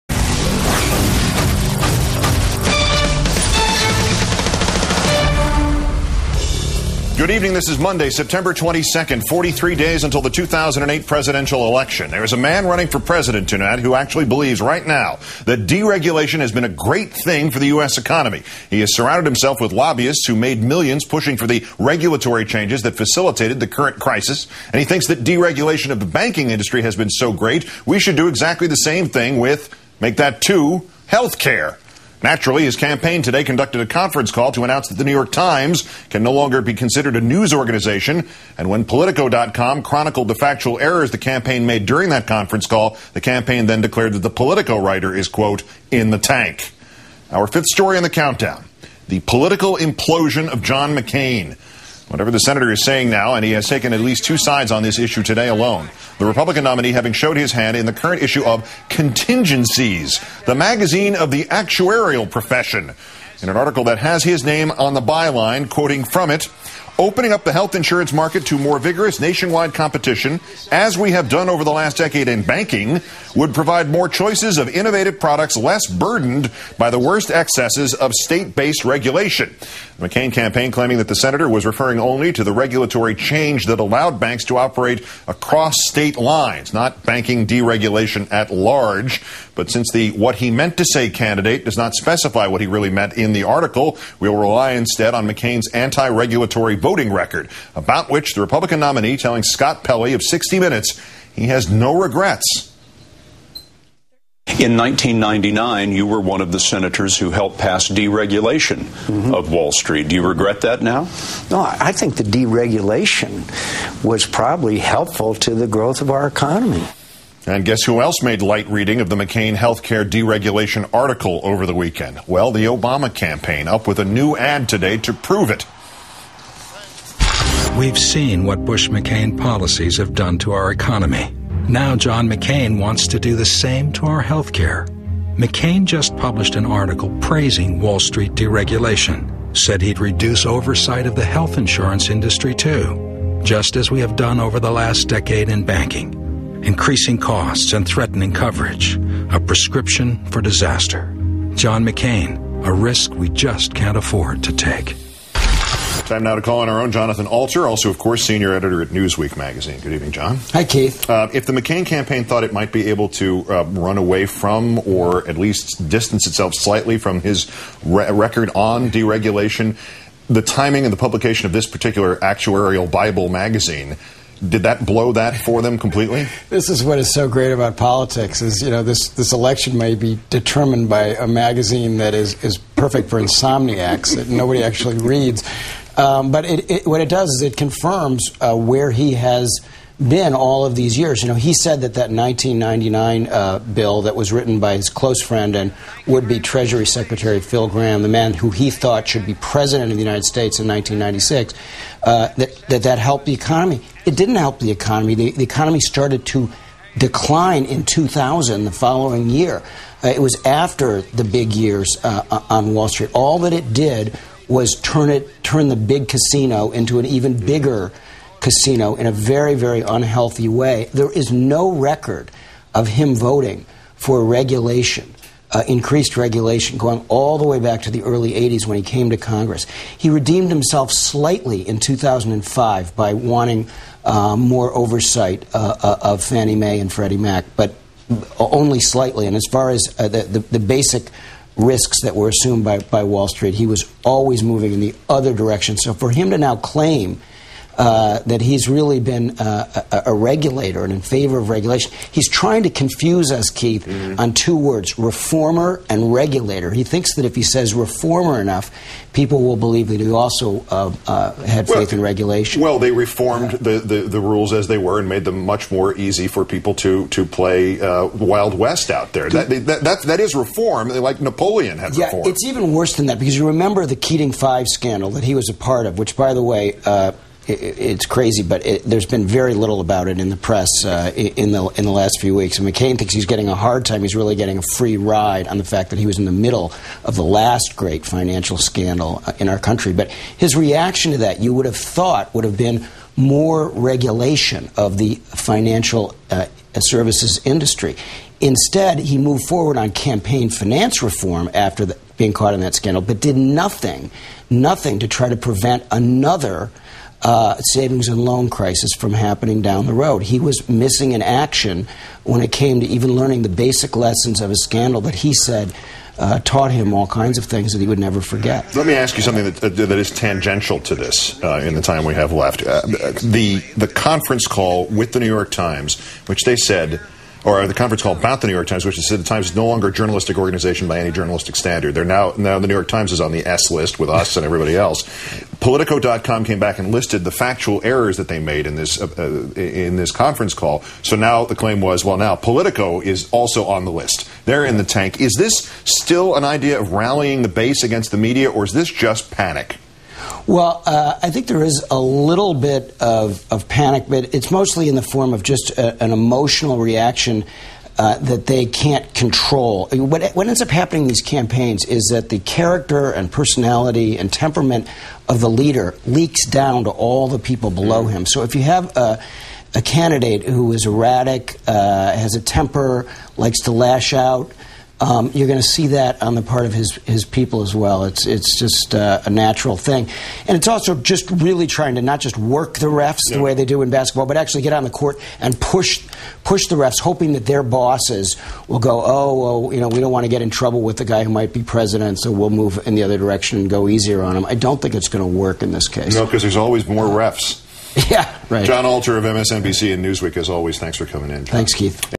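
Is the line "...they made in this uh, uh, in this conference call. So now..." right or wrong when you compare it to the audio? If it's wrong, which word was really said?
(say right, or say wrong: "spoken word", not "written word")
right.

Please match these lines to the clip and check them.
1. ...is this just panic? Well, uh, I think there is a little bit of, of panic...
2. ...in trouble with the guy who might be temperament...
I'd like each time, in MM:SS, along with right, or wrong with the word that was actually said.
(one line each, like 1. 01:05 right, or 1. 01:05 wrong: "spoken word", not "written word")
1. 05:48 right
2. 06:30 wrong: "president", not "temperament".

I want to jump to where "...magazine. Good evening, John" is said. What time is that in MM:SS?
02:39.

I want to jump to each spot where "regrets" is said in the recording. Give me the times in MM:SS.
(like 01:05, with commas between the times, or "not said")
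01:41, 01:50.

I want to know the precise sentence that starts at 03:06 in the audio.
Um, but it, it, what it does is it confirms uh, where he has been all of these years.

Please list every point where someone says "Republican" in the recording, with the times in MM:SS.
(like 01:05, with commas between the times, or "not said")
00:56, 01:38.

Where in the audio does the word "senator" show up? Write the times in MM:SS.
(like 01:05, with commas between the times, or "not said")
00:52, 01:21, 01:46.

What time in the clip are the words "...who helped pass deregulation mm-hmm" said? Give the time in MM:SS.
01:47.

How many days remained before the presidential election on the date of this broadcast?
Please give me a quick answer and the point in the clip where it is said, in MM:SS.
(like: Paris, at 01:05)
43, at 00:09.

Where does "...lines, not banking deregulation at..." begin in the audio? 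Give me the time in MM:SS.
01:26.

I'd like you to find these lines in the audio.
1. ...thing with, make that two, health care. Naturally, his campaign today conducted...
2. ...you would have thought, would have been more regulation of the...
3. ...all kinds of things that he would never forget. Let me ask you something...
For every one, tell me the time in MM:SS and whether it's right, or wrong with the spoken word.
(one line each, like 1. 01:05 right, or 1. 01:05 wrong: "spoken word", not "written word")
1. 00:29 right
2. 04:51 right
3. 05:16 right.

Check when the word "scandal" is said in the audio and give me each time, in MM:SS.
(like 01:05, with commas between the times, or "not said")
04:34, 04:48, 05:02, 05:14.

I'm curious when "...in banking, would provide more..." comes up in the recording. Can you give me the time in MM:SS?
01:12.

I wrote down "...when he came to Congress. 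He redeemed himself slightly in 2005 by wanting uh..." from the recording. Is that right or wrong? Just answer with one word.
right.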